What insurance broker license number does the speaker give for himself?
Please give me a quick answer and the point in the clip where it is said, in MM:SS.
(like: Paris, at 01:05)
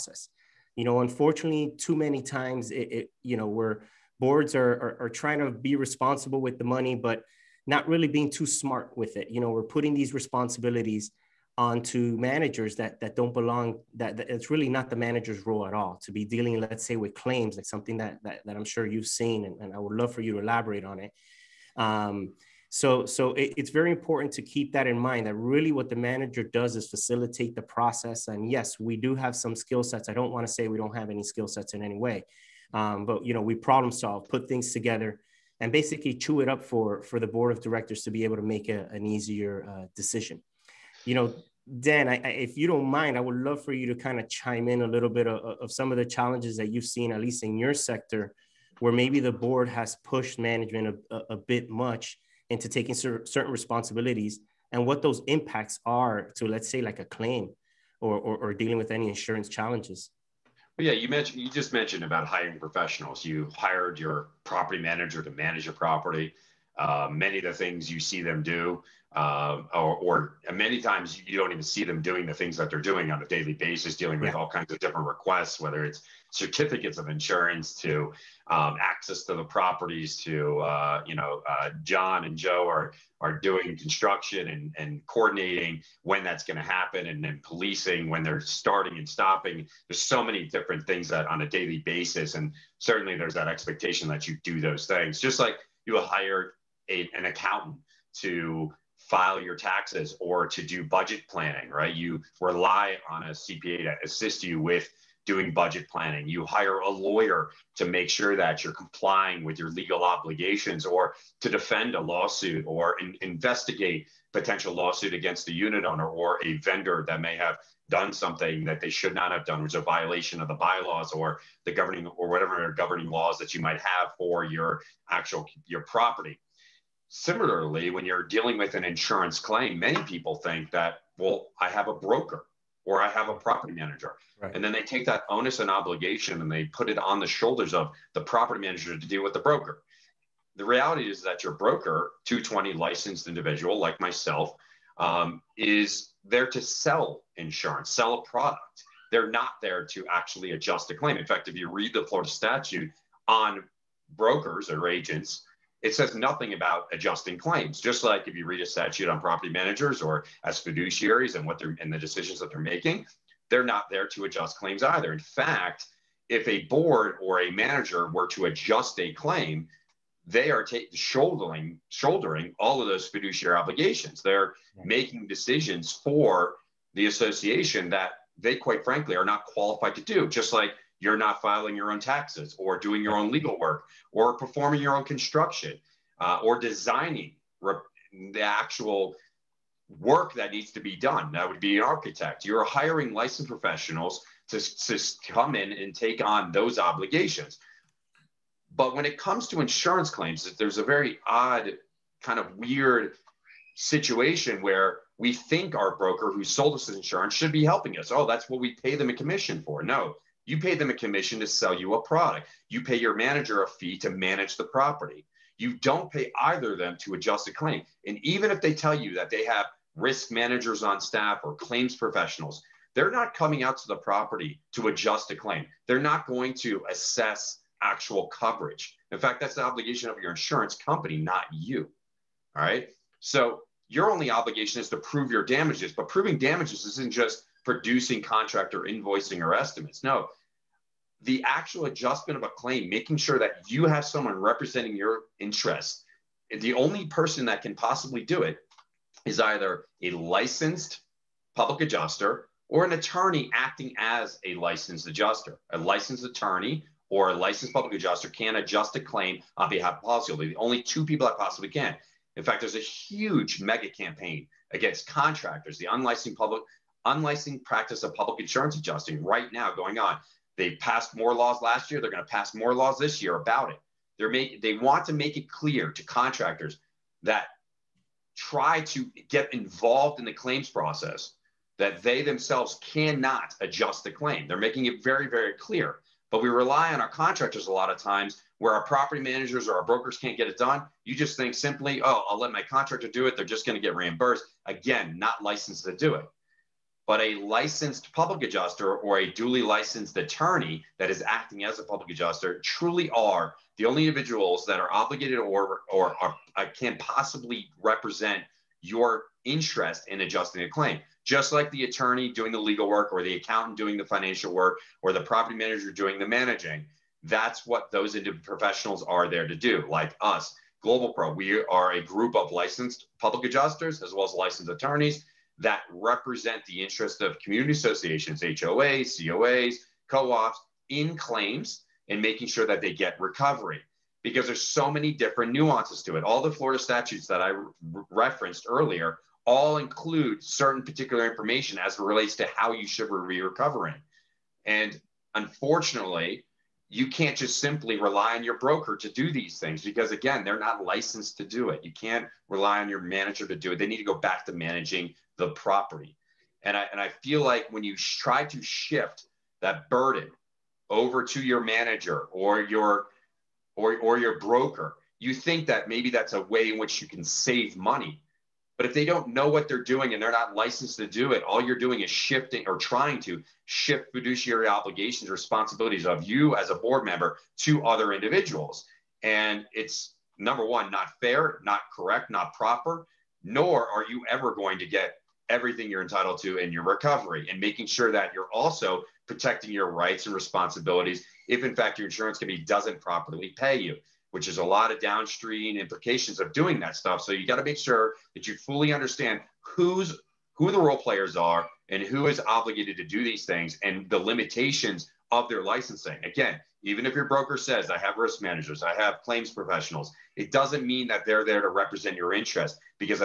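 220, at 02:22.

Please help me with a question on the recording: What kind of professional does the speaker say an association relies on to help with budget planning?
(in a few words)
CPA.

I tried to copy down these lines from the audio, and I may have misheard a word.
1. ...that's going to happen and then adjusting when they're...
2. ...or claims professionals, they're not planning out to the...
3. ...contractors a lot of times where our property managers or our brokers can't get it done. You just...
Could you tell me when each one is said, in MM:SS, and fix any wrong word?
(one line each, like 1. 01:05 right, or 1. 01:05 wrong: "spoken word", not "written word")
1. 01:26 wrong: "policing", not "adjusting"
2. 03:41 wrong: "coming", not "planning"
3. 04:47 right.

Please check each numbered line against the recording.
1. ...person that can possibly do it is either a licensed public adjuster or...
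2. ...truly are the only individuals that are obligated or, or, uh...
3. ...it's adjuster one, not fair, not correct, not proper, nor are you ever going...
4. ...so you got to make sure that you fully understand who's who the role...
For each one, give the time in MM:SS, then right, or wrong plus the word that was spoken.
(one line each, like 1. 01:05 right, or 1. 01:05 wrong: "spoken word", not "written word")
1. 04:07 right
2. 05:02 right
3. 06:19 wrong: "number", not "adjuster"
4. 06:37 right.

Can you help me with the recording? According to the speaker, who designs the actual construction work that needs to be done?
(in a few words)
An architect.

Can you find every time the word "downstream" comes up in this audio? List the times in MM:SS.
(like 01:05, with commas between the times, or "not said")
06:34.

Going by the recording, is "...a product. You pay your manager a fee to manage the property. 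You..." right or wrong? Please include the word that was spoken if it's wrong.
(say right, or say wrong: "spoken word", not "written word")
right.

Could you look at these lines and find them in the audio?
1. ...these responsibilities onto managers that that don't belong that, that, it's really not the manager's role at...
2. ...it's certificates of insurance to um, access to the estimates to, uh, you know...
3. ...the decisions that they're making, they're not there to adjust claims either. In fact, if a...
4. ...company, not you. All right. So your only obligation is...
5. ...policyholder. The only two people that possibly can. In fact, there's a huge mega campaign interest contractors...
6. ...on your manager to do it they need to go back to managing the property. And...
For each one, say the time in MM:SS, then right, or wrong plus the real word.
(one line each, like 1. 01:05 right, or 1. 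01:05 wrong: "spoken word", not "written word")
1. 00:09 right
2. 01:15 wrong: "properties", not "estimates"
3. 02:41 right
4. 03:50 right
5. 04:20 wrong: "against", not "interest"
6. 05:52 right.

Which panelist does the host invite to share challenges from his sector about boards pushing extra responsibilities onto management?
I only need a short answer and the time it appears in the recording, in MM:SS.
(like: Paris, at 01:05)
Dan, at 00:41.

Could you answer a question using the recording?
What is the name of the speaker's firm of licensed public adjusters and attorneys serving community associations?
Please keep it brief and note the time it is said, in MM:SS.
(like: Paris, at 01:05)
Global Pro, at 05:20.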